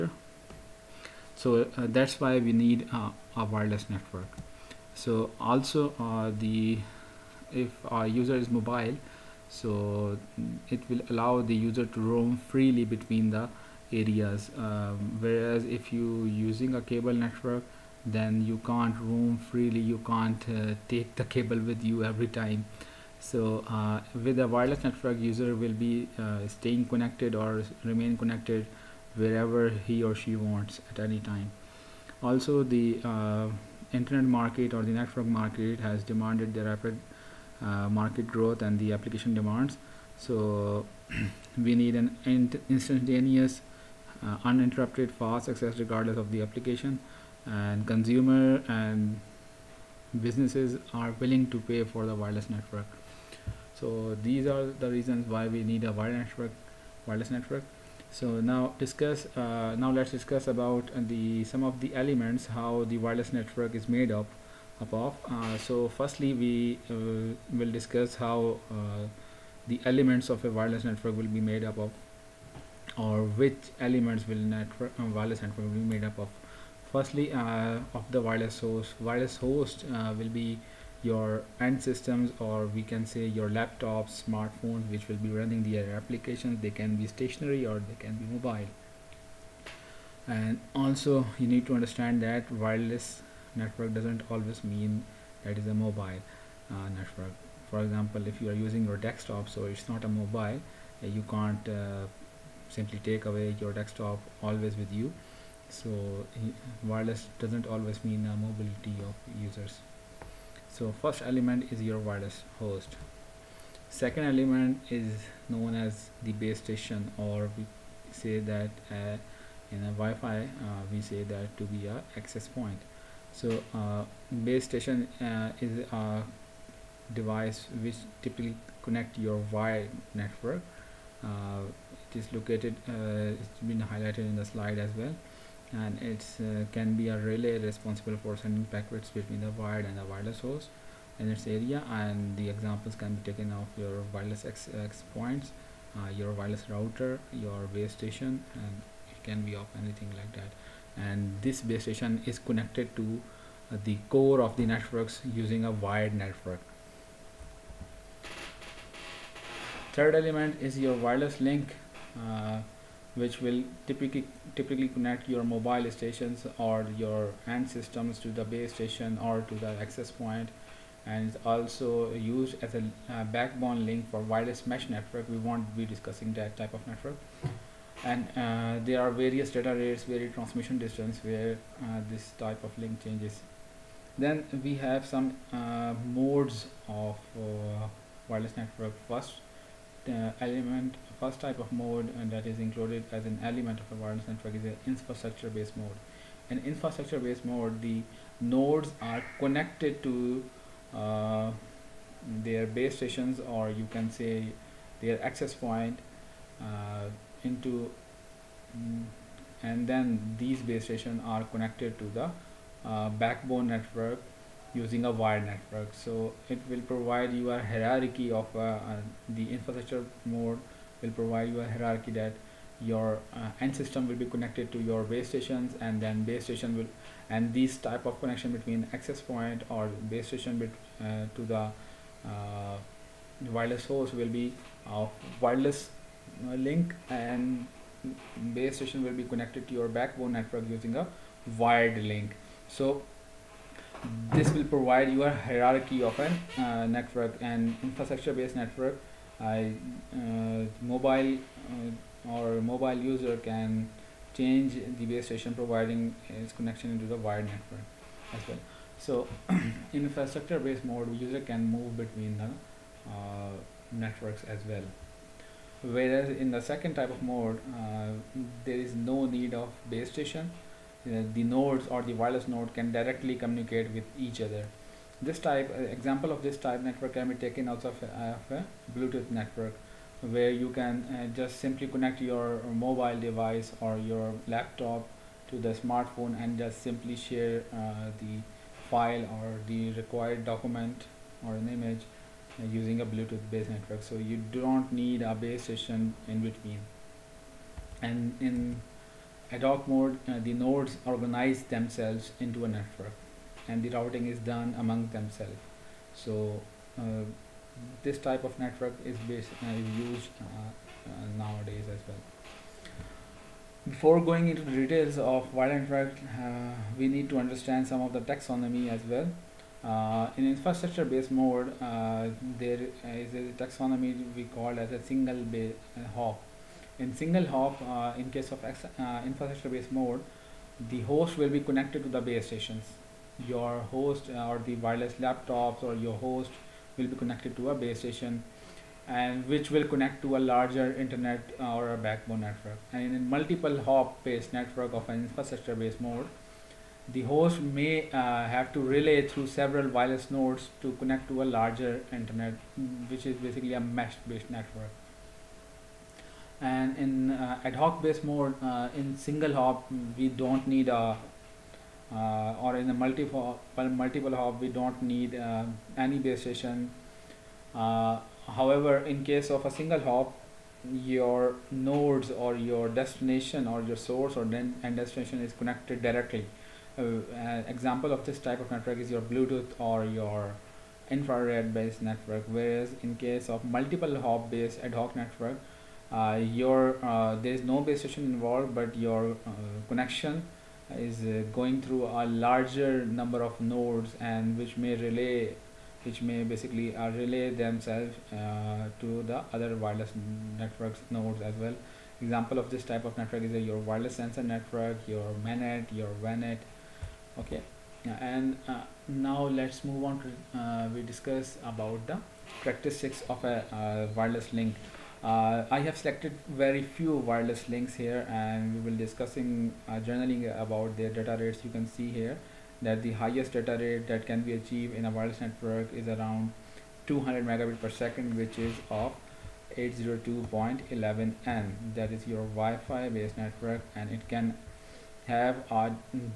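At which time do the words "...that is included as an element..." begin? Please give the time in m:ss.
3:12.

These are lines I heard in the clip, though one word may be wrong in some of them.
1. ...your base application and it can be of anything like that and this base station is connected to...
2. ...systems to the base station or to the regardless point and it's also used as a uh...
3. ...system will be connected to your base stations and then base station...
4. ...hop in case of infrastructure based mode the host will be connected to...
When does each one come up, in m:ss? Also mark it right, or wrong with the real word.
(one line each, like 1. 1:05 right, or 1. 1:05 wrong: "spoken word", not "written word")
1. 2:27 wrong: "station", not "application"
2. 2:47 wrong: "access", not "regardless"
3. 3:43 right
4. 5:27 right.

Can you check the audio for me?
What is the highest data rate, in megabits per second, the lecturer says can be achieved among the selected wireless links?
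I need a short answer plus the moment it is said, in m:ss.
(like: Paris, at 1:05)
200, at 7:07.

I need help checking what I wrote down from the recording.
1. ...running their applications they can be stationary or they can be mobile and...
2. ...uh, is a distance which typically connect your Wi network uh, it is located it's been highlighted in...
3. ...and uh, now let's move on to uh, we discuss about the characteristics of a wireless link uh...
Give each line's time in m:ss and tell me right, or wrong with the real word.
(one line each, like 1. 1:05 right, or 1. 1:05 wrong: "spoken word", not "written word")
1. 1:25 right
2. 2:05 wrong: "device", not "distance"
3. 6:48 right.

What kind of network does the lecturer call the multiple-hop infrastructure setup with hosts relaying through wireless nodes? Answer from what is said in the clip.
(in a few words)
mesh based network.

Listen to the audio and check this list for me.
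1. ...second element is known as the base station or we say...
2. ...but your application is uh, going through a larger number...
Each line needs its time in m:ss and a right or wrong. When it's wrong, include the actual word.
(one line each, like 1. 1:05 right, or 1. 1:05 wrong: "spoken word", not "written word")
1. 1:53 right
2. 6:28 wrong: "connection", not "application".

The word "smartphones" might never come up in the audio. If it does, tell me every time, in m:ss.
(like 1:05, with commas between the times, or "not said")
1:24, 4:45.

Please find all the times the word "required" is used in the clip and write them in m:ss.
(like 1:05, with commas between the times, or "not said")
4:49.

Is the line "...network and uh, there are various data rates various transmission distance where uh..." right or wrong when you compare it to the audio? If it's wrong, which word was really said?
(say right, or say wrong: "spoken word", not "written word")
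right.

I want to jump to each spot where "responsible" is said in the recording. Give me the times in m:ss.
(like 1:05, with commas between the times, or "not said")
2:17.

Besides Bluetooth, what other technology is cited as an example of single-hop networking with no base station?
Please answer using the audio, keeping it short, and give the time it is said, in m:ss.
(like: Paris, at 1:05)
infrared, at 6:21.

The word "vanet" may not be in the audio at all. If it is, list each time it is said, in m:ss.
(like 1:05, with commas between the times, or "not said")
6:46.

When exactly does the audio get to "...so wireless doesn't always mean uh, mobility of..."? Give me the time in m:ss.
1:45.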